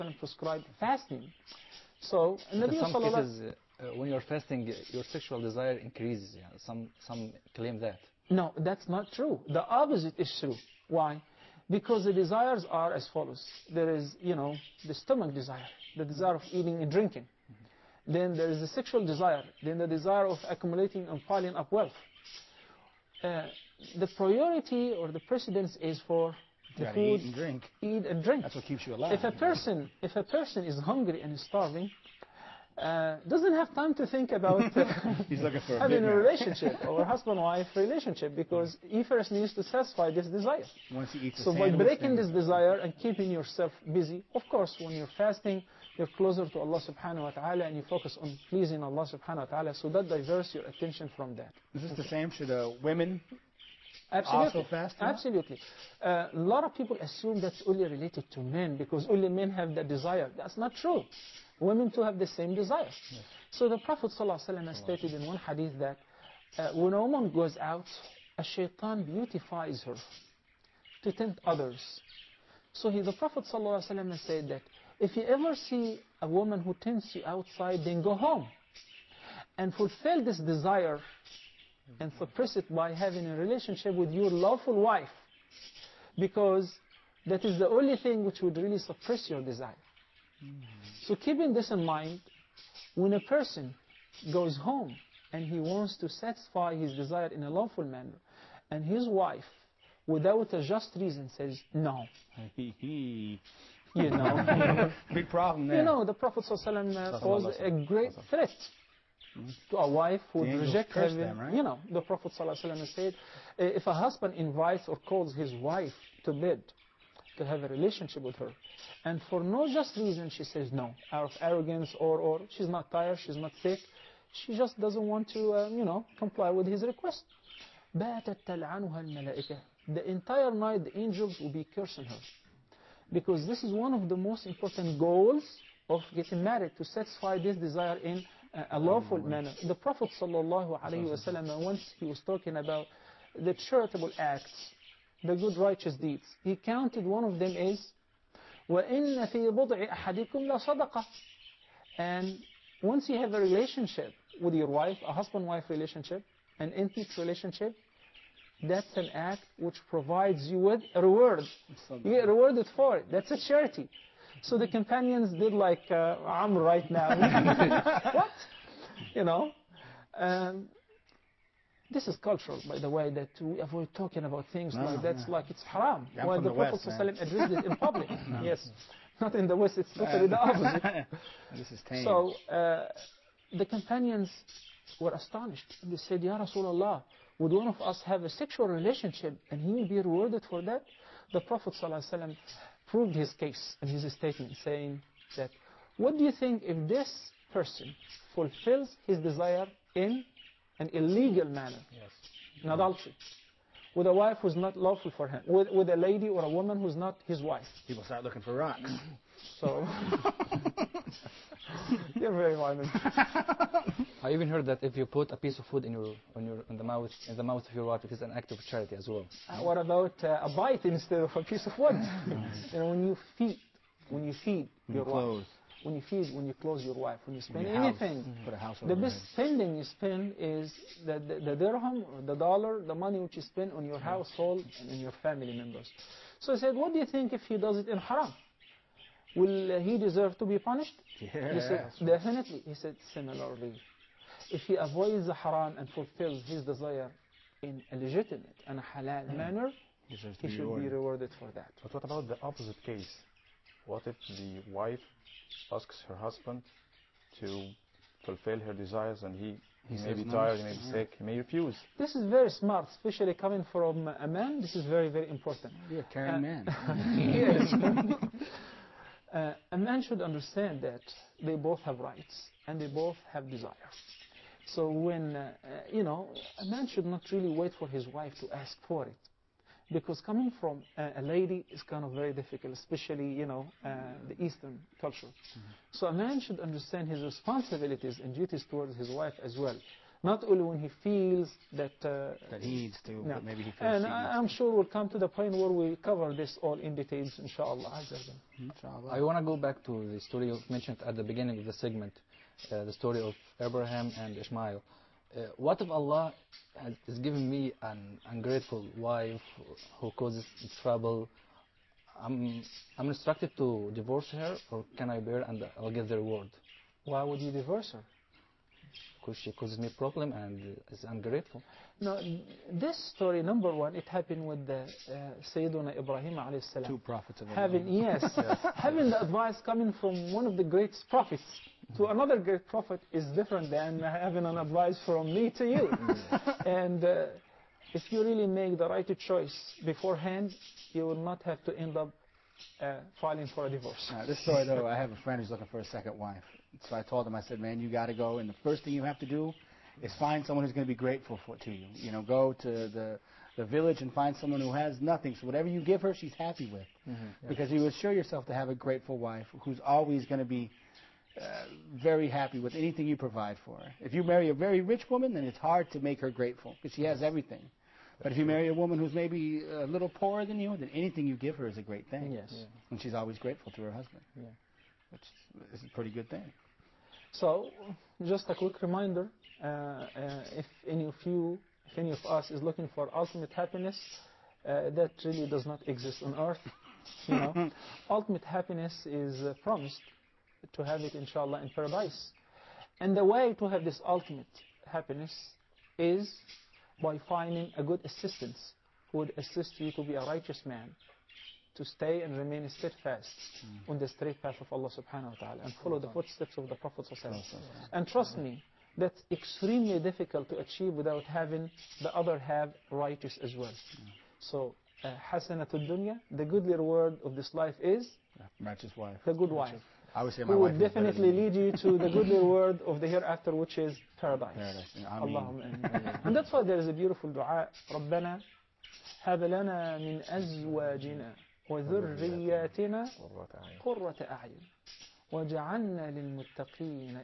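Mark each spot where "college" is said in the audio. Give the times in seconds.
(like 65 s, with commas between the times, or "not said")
not said.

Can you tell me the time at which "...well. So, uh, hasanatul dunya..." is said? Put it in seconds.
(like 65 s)
413 s.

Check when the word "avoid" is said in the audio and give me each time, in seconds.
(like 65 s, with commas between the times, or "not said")
173 s, 244 s.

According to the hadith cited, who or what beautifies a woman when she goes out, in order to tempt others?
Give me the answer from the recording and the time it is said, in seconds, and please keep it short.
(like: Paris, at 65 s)
Shaitan, at 68 s.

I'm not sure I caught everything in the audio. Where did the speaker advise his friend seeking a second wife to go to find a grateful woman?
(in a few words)
The village.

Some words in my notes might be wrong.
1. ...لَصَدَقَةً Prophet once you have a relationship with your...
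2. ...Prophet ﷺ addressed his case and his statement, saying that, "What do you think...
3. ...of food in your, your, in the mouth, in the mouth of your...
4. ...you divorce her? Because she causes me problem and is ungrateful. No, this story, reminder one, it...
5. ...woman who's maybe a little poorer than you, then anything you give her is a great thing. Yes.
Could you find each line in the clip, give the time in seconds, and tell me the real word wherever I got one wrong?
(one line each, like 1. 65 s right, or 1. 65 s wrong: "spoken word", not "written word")
1. 150 s wrong: "And", not "Prophet"
2. 191 s wrong: "proved", not "addressed"
3. 215 s right
4. 317 s wrong: "number", not "reminder"
5. 368 s right.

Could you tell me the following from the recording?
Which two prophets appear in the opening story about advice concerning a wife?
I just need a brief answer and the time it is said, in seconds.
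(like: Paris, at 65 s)
Abraham and Ishmael, at 303 s.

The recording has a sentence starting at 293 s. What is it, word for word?
maybe he feels And he I, am sure we'll come to the point where we cover this all in details, inshallah.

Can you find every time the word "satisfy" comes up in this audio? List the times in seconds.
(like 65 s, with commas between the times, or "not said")
39 s, 96 s, 136 s.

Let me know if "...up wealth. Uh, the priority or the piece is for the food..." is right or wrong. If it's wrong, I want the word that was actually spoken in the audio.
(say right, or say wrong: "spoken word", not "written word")
wrong: "precedence", not "piece".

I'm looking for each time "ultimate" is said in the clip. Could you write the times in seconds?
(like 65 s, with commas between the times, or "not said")
383 s, 388 s, 394 s.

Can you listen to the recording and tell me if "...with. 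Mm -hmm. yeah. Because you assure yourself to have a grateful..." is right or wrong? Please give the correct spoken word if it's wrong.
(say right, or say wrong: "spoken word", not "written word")
right.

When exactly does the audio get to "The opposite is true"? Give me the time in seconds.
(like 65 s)
9 s.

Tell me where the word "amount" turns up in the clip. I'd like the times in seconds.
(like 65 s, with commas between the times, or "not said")
not said.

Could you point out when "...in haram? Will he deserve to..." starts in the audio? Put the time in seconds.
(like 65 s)
237 s.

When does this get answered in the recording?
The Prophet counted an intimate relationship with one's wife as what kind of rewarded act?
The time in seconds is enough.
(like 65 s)
163 s.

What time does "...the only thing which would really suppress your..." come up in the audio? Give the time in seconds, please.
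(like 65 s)
87 s.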